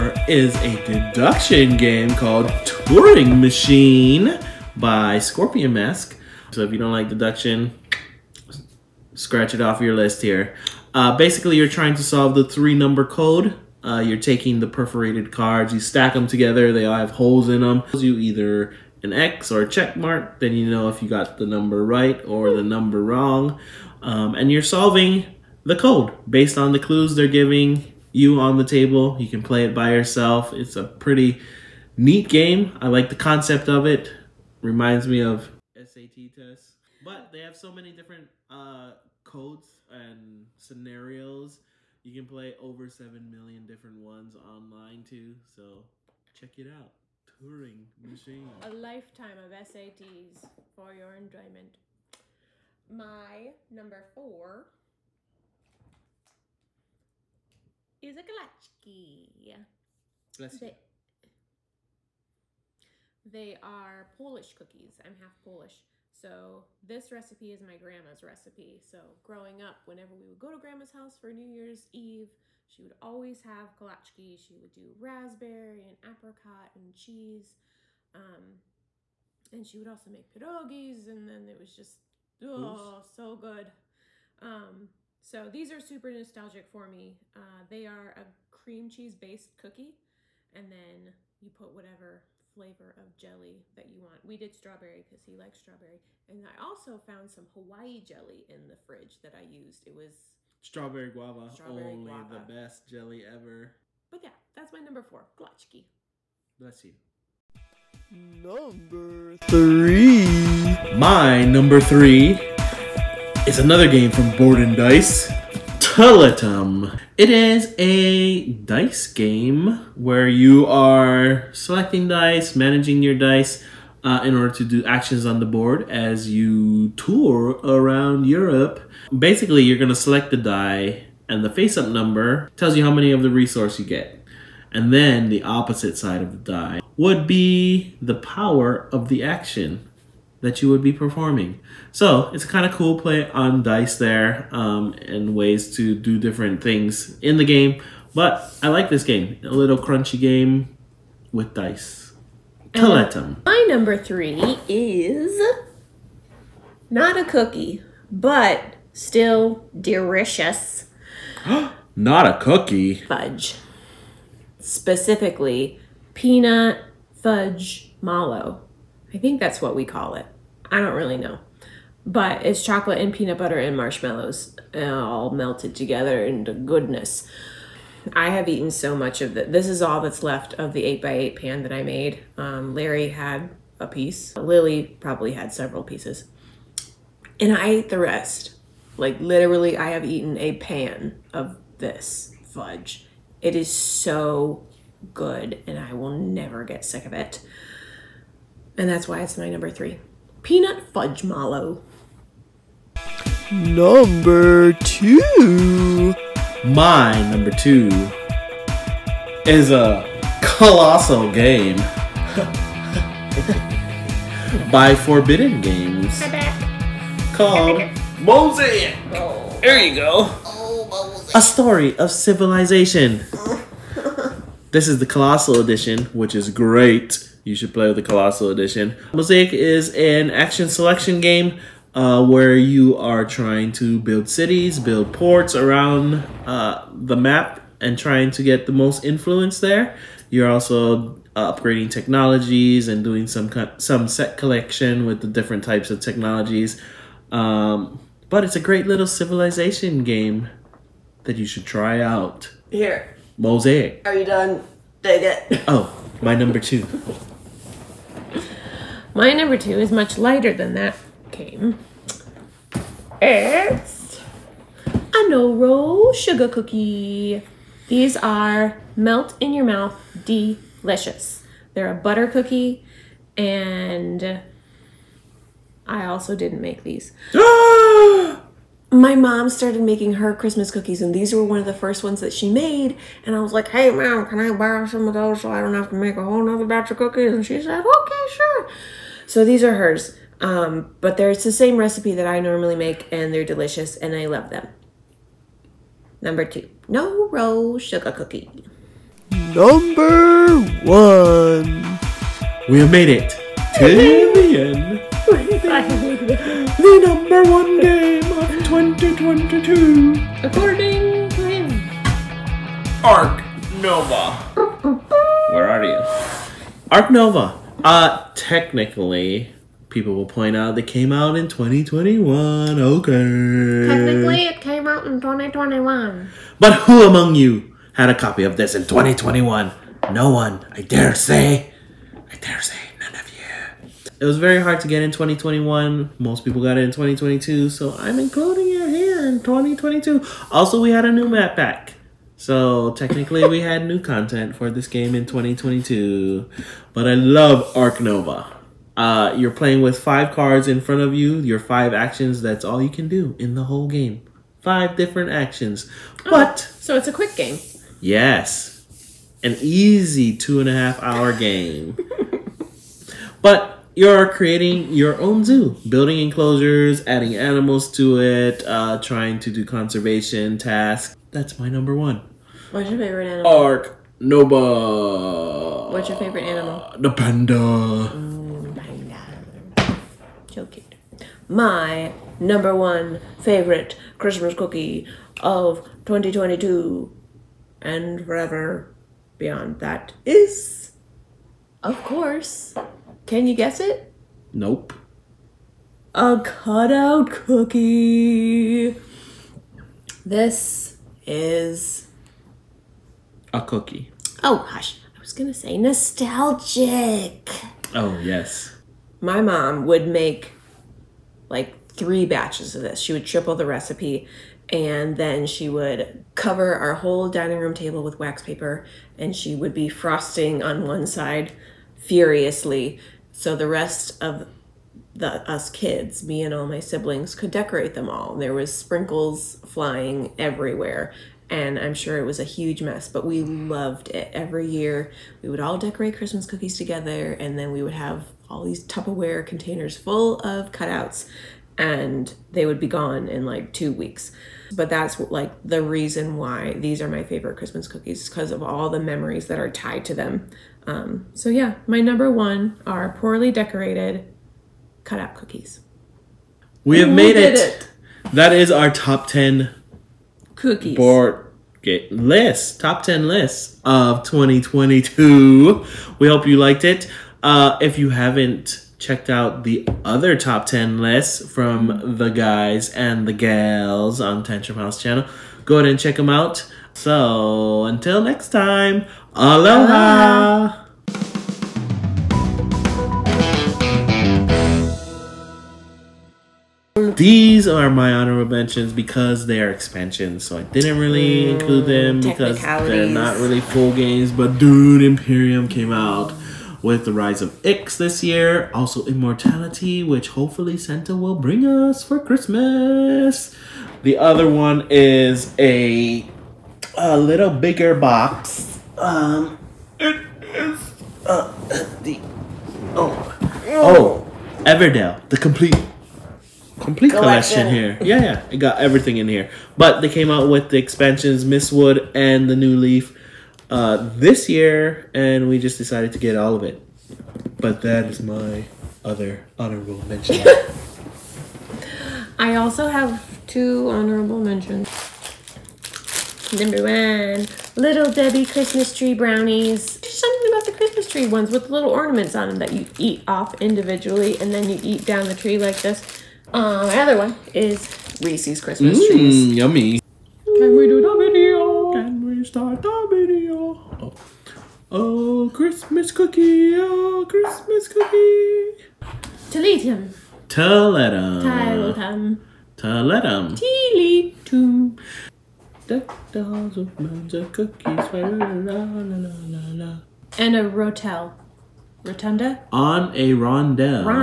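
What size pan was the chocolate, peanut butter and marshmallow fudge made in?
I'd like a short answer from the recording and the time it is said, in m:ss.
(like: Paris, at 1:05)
8x8, at 3:00.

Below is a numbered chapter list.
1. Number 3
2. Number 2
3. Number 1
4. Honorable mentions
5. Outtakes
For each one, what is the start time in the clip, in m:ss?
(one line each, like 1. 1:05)
1. 1:47
2. 3:24
3. 5:00
4. 8:07
5. 9:10.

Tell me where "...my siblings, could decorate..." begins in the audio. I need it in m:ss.
7:06.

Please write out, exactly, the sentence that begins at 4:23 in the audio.
It's a no roll sugar cookie.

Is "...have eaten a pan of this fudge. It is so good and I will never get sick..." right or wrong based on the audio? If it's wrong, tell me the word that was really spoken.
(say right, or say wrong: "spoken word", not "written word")
right.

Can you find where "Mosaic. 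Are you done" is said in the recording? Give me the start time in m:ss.
4:13.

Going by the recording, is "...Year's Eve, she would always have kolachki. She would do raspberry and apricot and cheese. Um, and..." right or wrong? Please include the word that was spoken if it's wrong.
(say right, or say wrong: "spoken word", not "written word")
right.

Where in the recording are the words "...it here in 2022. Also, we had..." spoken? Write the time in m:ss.
5:38.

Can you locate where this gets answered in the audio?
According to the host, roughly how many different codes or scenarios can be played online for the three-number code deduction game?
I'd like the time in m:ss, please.
0:42.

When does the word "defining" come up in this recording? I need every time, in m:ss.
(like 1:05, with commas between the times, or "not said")
not said.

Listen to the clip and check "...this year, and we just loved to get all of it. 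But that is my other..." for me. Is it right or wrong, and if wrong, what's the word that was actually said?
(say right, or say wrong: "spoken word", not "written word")
wrong: "decided", not "loved".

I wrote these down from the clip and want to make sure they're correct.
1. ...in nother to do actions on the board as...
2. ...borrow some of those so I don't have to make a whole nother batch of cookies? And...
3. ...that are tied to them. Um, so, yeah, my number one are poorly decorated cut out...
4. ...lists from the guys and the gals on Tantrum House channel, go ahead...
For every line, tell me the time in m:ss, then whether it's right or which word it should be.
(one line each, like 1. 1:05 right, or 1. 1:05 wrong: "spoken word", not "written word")
1. 2:04 wrong: "order", not "nother"
2. 4:44 right
3. 7:29 right
4. 7:50 right.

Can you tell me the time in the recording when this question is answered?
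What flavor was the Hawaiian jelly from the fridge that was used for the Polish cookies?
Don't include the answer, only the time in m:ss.
1:40.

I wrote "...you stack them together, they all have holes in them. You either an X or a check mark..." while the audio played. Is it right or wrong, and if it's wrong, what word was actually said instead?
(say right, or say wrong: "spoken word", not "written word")
right.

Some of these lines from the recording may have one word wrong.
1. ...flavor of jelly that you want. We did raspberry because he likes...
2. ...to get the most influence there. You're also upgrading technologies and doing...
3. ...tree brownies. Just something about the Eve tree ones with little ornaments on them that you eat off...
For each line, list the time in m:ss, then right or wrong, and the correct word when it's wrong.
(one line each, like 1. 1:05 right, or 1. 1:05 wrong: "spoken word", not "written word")
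1. 1:32 wrong: "strawberry", not "raspberry"
2. 3:58 right
3. 8:58 wrong: "Christmas", not "Eve".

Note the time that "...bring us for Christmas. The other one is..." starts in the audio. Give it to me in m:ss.
8:21.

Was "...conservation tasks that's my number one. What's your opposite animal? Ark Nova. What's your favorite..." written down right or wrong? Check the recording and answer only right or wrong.
wrong.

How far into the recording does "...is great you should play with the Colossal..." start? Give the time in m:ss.
3:46.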